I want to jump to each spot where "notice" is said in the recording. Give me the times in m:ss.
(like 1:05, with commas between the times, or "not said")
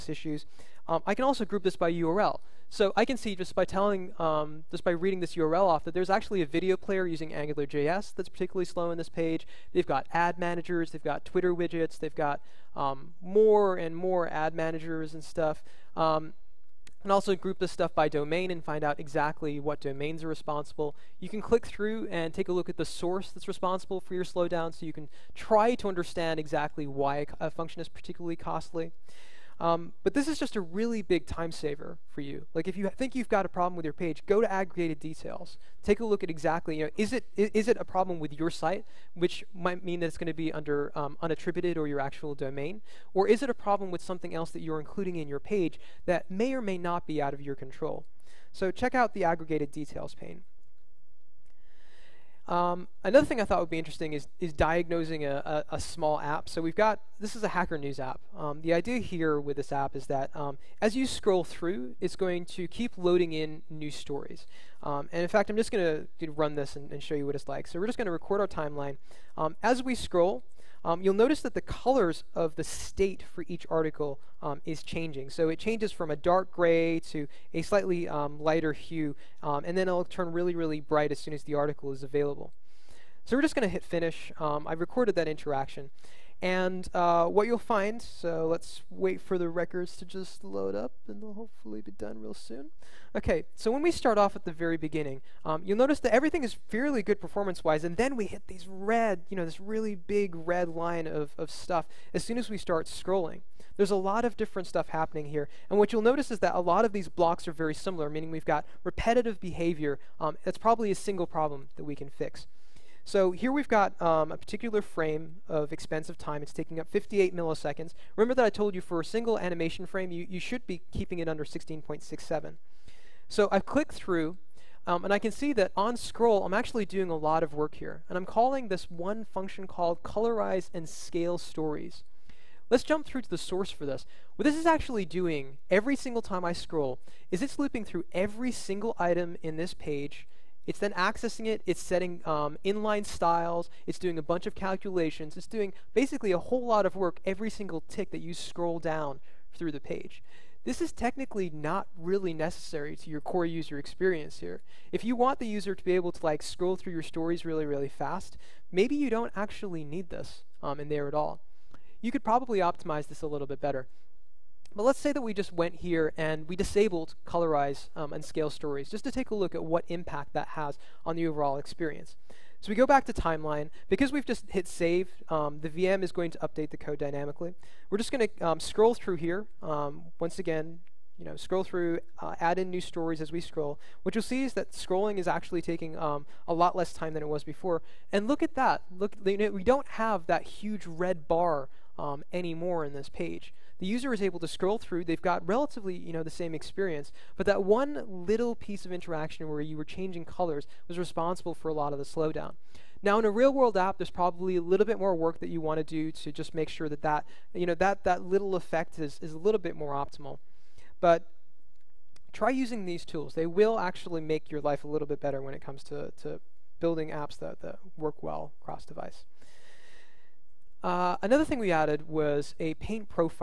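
1:11, 1:35, 1:46.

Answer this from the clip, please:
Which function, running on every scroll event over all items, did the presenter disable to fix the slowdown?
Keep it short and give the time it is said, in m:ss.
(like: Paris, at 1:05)
colorize and scale stories, at 2:10.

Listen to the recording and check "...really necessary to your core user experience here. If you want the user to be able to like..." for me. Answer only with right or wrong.
right.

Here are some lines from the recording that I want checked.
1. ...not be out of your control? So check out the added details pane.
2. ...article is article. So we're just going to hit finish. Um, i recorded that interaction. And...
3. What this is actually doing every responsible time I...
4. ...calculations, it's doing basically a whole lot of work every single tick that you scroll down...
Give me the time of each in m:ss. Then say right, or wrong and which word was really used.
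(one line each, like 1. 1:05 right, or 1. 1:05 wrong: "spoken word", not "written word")
1. 0:46 wrong: "aggregated", not "added"
2. 1:21 wrong: "available", not "article"
3. 2:14 wrong: "single", not "responsible"
4. 2:24 right.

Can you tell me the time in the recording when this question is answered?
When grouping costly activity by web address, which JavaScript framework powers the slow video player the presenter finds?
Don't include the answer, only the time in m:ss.
0:07.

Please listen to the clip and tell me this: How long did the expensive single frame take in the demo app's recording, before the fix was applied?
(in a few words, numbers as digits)
58 milliseconds.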